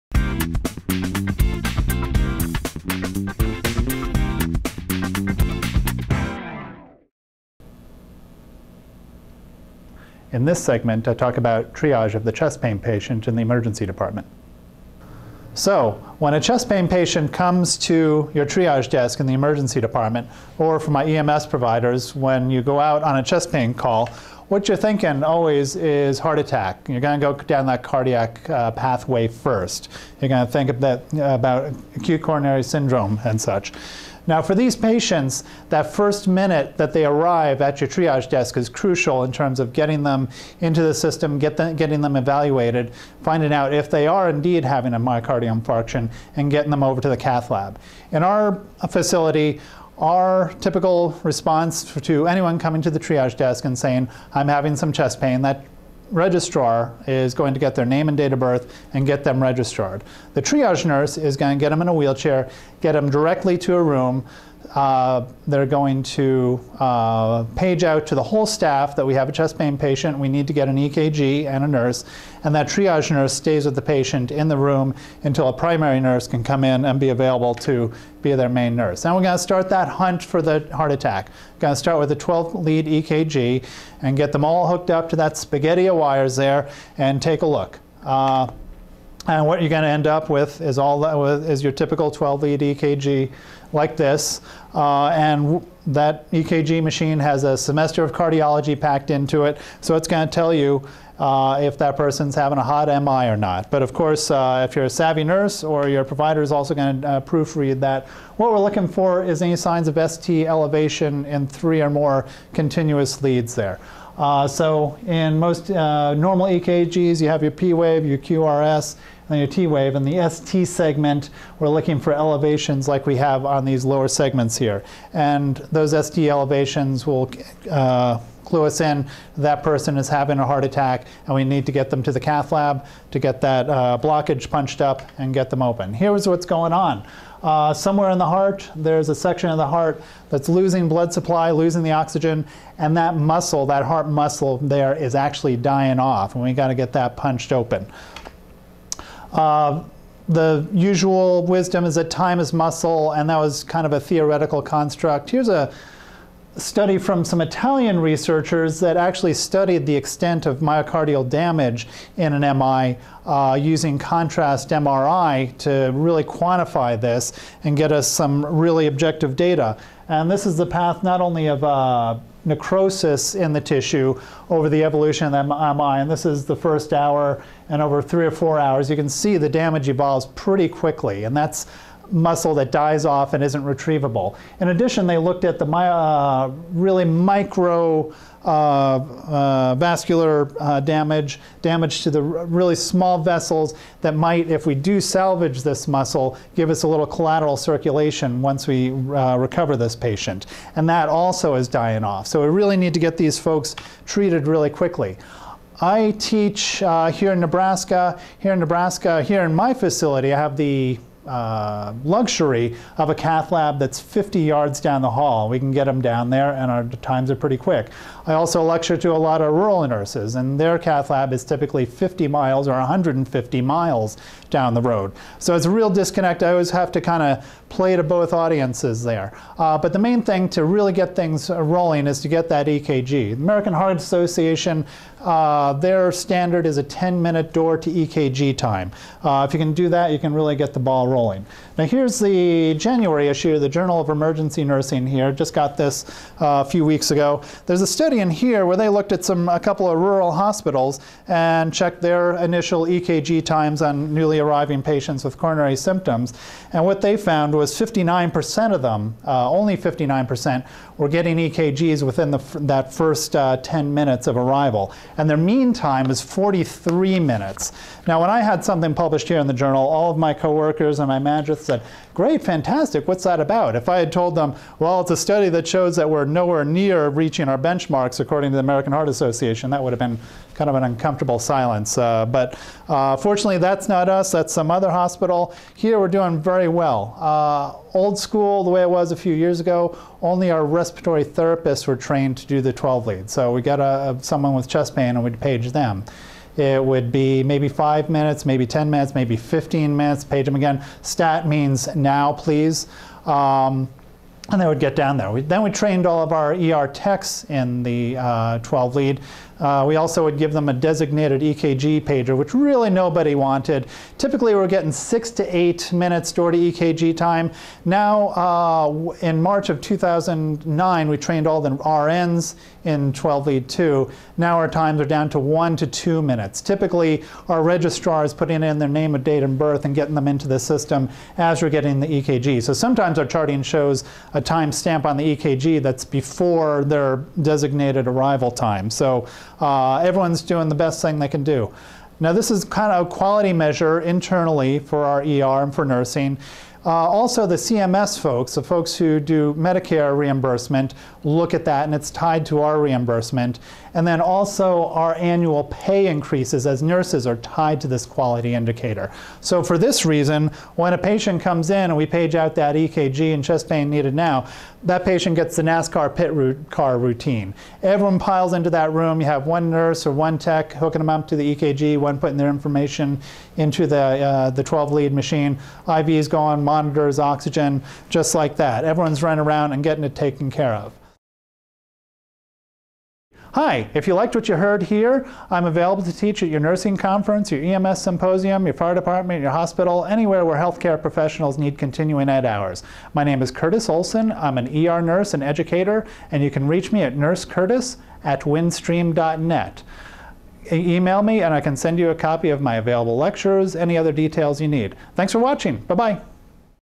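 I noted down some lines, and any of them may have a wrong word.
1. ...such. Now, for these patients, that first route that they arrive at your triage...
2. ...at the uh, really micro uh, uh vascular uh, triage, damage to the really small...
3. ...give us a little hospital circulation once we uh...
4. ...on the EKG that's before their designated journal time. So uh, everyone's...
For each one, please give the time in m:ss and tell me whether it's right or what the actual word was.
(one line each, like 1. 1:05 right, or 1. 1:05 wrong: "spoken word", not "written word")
1. 0:33 wrong: "minute", not "route"
2. 3:05 wrong: "damage", not "triage"
3. 3:16 wrong: "collateral", not "hospital"
4. 5:35 wrong: "arrival", not "journal".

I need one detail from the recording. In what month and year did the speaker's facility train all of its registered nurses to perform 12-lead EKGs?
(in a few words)
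March 2009.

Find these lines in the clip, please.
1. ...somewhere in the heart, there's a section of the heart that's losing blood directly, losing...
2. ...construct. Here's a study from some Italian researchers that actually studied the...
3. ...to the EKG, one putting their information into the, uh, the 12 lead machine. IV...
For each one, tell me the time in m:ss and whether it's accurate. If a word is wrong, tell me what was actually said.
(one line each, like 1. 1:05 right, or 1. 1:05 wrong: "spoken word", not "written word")
1. 2:17 wrong: "supply", not "directly"
2. 2:34 right
3. 6:11 right.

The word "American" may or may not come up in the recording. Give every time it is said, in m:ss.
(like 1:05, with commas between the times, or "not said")
3:53, 4:38.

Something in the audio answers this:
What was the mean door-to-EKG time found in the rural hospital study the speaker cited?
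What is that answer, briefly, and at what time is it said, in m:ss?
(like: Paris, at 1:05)
43 minutes, at 4:26.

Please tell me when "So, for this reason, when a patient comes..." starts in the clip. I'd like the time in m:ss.
5:59.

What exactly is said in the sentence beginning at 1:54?
Uh, so in most uh, normal EKGs, you have your P wave, your QRS, and your T wave.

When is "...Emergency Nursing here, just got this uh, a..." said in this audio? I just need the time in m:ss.
4:04.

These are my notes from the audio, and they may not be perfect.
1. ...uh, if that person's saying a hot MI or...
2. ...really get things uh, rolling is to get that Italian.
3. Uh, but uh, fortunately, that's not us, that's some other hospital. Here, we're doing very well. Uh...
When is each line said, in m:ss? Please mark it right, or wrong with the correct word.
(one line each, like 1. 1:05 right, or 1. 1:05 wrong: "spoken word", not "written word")
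1. 1:41 wrong: "having", not "saying"
2. 3:50 wrong: "EKG", not "Italian"
3. 4:41 right.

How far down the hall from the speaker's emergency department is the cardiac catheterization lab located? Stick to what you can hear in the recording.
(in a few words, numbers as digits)
50 yards.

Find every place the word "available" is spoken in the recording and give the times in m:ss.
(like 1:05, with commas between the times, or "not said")
1:17, 6:25, 6:42.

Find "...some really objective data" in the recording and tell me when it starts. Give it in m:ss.
2:48.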